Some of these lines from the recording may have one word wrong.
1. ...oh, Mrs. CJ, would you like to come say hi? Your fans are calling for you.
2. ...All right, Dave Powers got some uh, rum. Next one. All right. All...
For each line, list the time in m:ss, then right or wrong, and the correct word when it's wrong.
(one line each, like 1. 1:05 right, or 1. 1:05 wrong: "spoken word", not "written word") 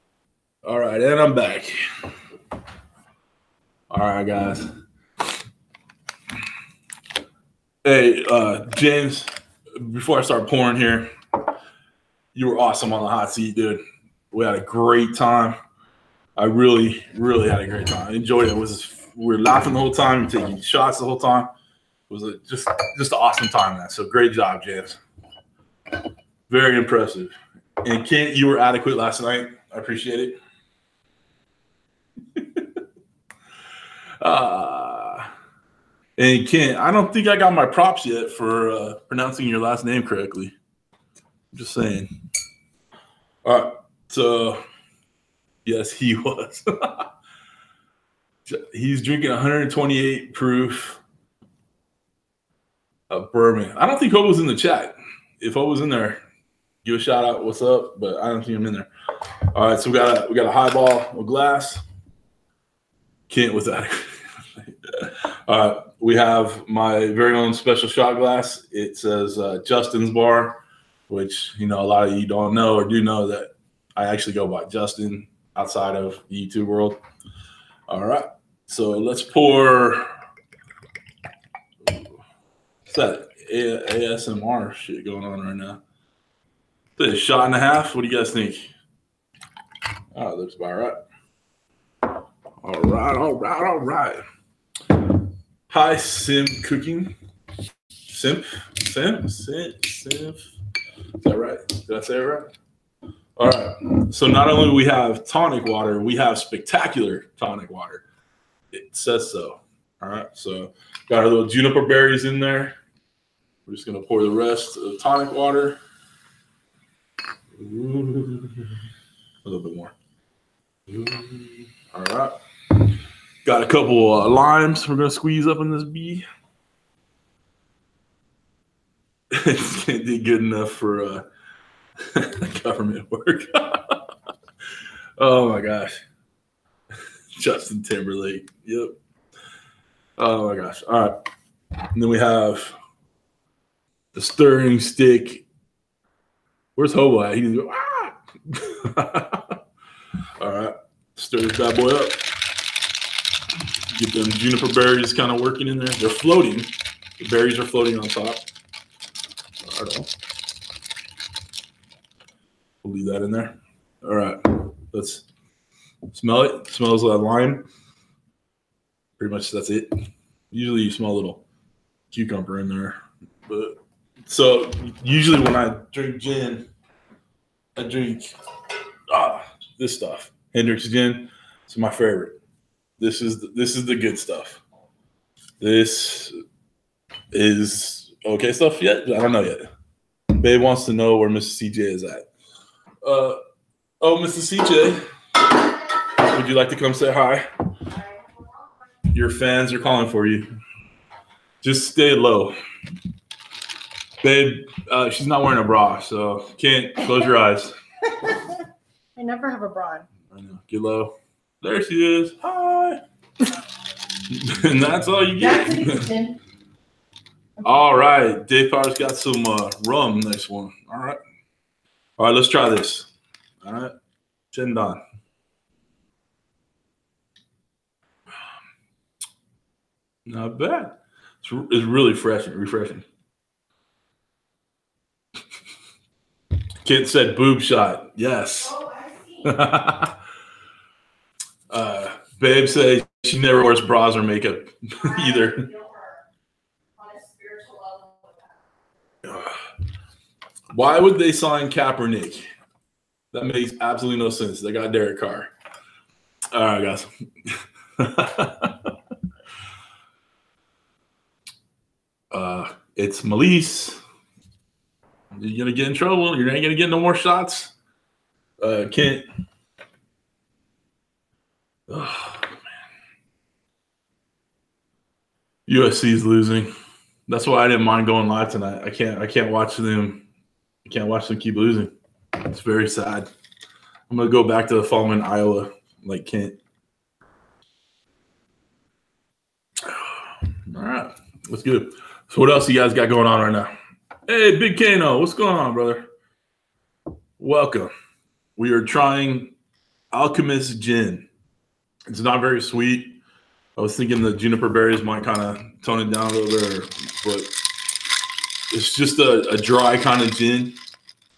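1. 3:13 right
2. 3:37 right.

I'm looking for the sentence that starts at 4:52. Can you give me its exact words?
So what else you guys got going on right now?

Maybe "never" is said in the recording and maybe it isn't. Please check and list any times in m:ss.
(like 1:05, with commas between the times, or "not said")
3:29, 4:03.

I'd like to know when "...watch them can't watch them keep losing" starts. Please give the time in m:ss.
4:39.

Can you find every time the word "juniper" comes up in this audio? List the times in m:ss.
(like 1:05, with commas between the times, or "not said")
1:51, 2:34, 5:04.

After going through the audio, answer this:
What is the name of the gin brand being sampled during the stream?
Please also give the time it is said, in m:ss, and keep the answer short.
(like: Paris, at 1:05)
Alkkemist, at 5:00.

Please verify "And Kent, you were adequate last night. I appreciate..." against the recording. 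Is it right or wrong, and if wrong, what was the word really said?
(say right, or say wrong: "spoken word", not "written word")
right.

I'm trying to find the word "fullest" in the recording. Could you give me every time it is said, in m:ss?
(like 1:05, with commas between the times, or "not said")
not said.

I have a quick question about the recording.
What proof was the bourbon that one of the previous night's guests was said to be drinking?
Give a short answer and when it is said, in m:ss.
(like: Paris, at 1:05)
128, at 0:49.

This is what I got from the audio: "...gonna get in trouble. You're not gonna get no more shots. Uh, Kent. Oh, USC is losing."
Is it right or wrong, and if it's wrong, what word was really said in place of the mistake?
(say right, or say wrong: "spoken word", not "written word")
right.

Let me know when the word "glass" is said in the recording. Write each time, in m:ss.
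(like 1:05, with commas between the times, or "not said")
1:01, 1:08.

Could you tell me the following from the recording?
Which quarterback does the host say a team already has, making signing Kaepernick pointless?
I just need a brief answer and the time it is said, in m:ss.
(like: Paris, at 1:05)
Derek Carr, at 4:14.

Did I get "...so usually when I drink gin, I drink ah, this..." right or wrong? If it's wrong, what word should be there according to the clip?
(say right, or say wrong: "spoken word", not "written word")
right.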